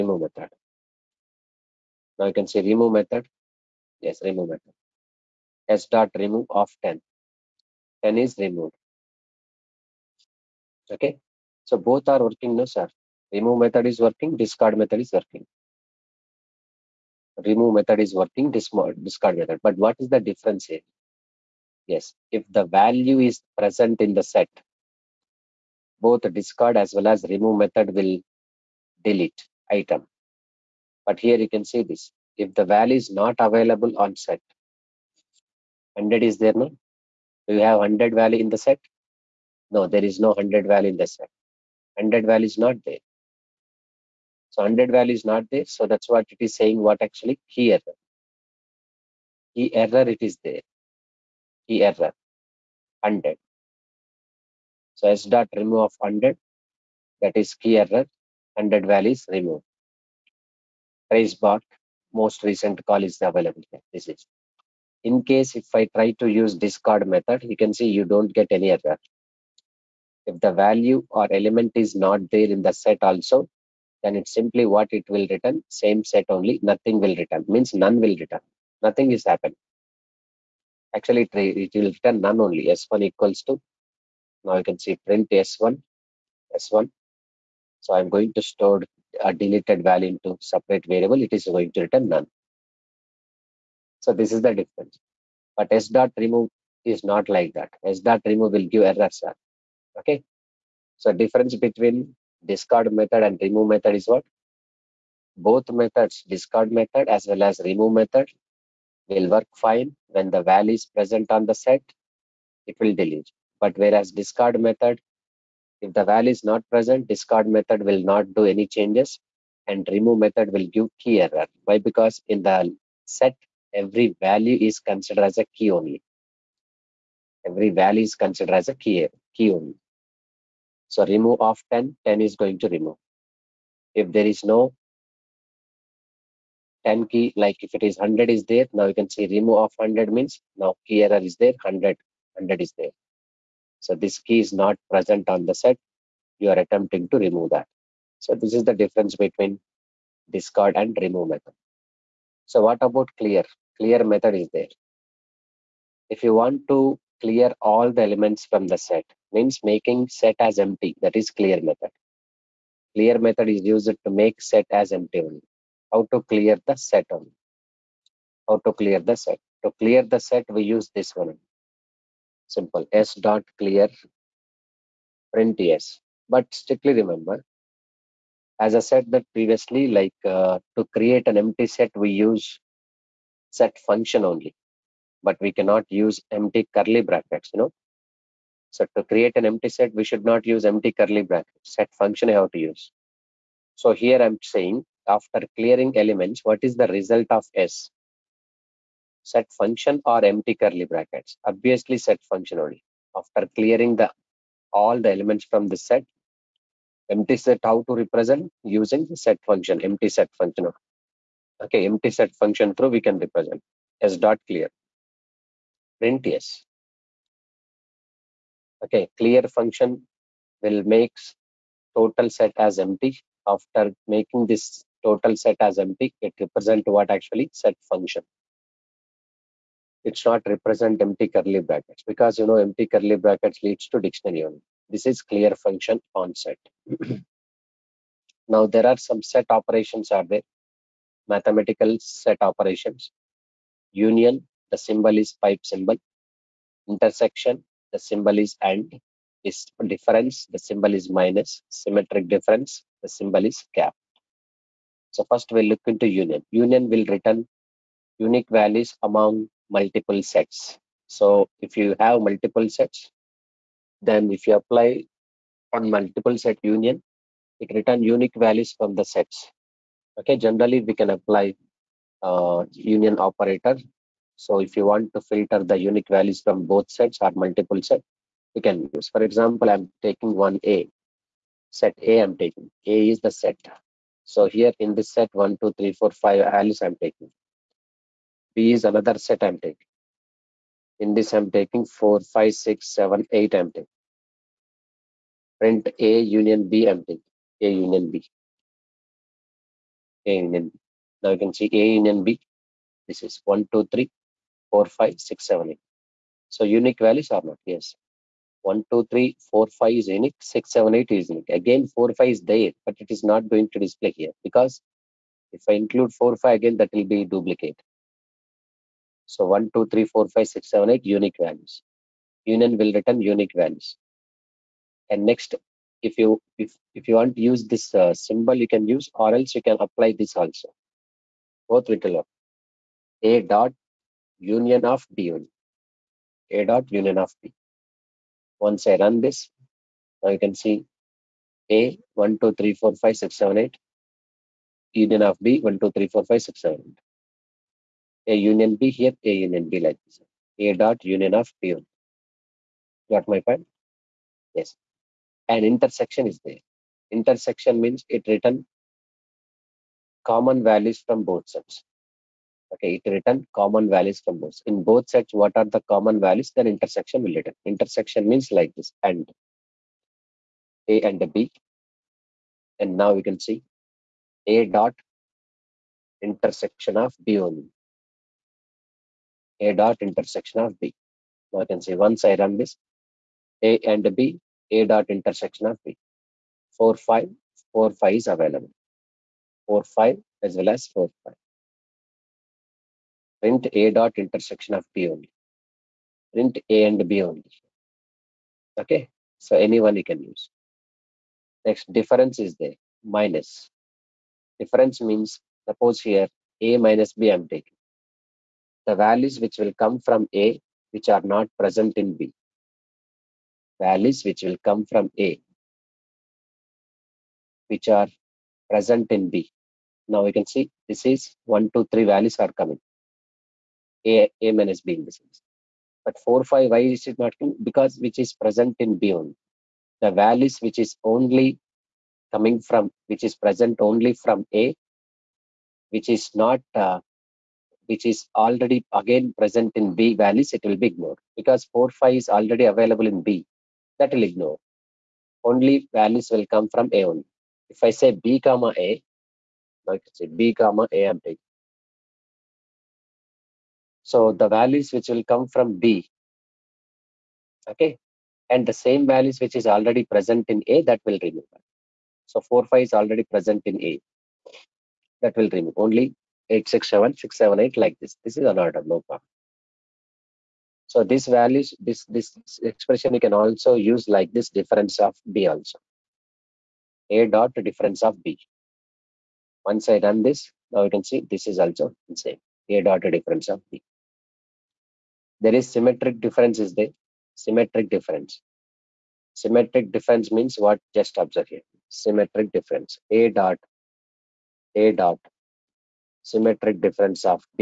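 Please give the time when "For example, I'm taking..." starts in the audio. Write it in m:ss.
4:39.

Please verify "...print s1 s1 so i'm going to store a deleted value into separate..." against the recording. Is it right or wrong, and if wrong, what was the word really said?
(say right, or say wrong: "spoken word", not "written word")
right.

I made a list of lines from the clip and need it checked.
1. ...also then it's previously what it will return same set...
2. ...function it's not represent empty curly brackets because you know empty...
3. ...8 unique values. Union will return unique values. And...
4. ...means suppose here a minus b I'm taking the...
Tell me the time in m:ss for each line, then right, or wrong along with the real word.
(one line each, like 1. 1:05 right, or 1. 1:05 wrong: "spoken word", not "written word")
1. 1:13 wrong: "simply", not "previously"
2. 3:47 right
3. 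5:20 right
4. 6:45 right.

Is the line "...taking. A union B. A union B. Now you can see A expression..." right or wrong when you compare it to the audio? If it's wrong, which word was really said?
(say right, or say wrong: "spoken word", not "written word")
wrong: "union", not "expression".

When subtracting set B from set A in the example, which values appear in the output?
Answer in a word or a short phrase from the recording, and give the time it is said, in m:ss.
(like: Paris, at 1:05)
1, 2, 3, at 7:01.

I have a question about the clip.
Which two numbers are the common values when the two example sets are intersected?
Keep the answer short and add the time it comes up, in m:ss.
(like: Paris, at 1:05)
4, 5, at 6:26.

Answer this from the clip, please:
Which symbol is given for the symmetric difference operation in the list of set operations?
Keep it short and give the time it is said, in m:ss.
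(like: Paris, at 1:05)
cap, at 4:11.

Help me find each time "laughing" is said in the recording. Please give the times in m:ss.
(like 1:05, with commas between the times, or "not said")
not said.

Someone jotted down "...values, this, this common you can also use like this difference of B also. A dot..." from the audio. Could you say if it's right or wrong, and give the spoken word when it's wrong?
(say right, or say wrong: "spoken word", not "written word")
wrong: "expression", not "common".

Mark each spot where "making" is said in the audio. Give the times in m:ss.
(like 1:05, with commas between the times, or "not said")
2:39, 3:44.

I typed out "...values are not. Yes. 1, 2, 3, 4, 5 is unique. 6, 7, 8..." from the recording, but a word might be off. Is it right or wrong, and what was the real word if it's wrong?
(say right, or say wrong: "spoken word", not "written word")
right.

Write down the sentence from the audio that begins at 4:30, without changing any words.
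Okay, generally we can apply uh, union operator.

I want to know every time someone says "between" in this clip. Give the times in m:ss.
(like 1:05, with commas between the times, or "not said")
1:41, 2:29.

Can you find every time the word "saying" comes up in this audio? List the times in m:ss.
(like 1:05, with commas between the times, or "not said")
0:46, 3:14.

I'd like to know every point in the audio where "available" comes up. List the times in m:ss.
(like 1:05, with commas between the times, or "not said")
0:33, 1:03, 6:28, 7:22.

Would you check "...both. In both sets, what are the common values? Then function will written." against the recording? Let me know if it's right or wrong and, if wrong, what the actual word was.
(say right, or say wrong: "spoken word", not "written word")
wrong: "intersection", not "function".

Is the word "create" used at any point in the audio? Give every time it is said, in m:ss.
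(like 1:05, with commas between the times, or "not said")
3:00, 3:09.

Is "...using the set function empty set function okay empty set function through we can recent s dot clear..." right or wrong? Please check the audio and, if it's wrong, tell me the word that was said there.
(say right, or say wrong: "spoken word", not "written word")
wrong: "represent", not "recent".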